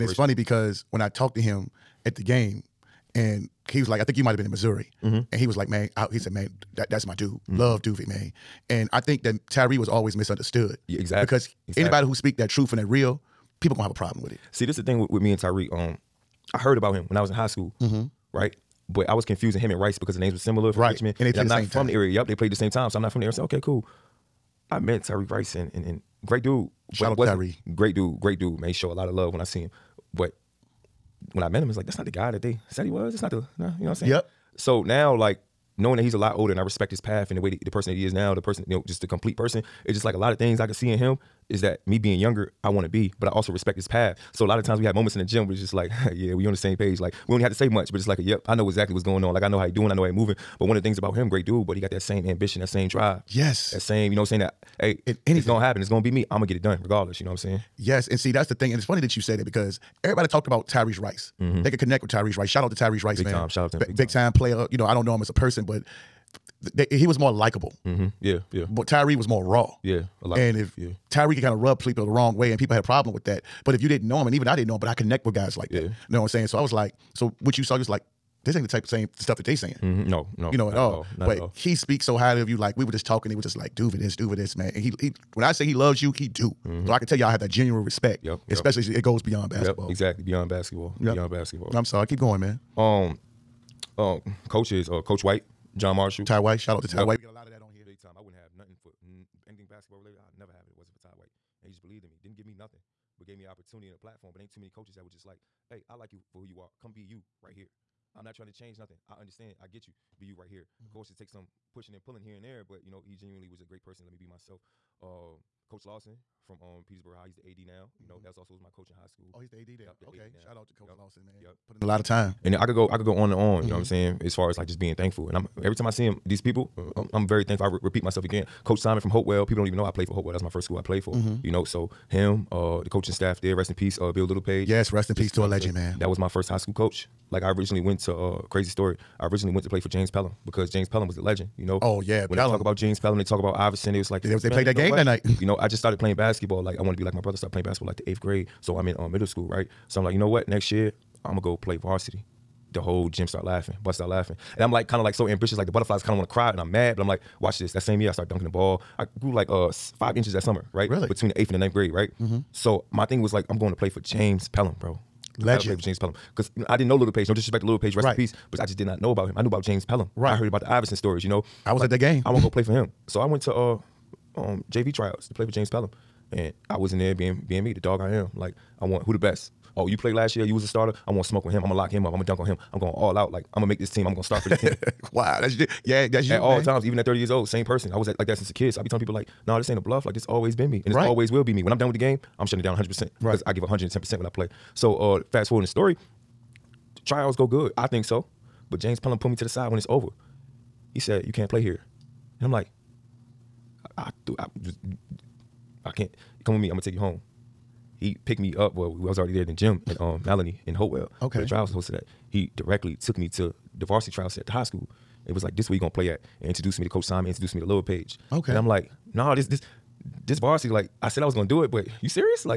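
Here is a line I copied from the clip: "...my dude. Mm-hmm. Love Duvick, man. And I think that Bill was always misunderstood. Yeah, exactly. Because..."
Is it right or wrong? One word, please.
wrong.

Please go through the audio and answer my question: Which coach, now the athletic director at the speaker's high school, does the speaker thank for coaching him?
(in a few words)
Coach Lawson.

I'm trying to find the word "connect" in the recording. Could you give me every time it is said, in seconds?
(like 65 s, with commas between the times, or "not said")
61 s, 74 s.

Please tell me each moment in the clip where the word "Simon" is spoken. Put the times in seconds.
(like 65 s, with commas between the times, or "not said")
128 s, 217 s.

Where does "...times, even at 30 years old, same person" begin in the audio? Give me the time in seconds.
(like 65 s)
186 s.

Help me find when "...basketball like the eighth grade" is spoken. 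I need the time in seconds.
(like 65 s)
147 s.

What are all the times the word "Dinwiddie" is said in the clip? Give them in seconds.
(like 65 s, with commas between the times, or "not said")
not said.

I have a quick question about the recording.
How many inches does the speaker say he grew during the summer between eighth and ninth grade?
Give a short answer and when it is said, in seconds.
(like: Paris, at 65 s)
5, at 159 s.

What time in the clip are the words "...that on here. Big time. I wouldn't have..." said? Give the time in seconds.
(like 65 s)
97 s.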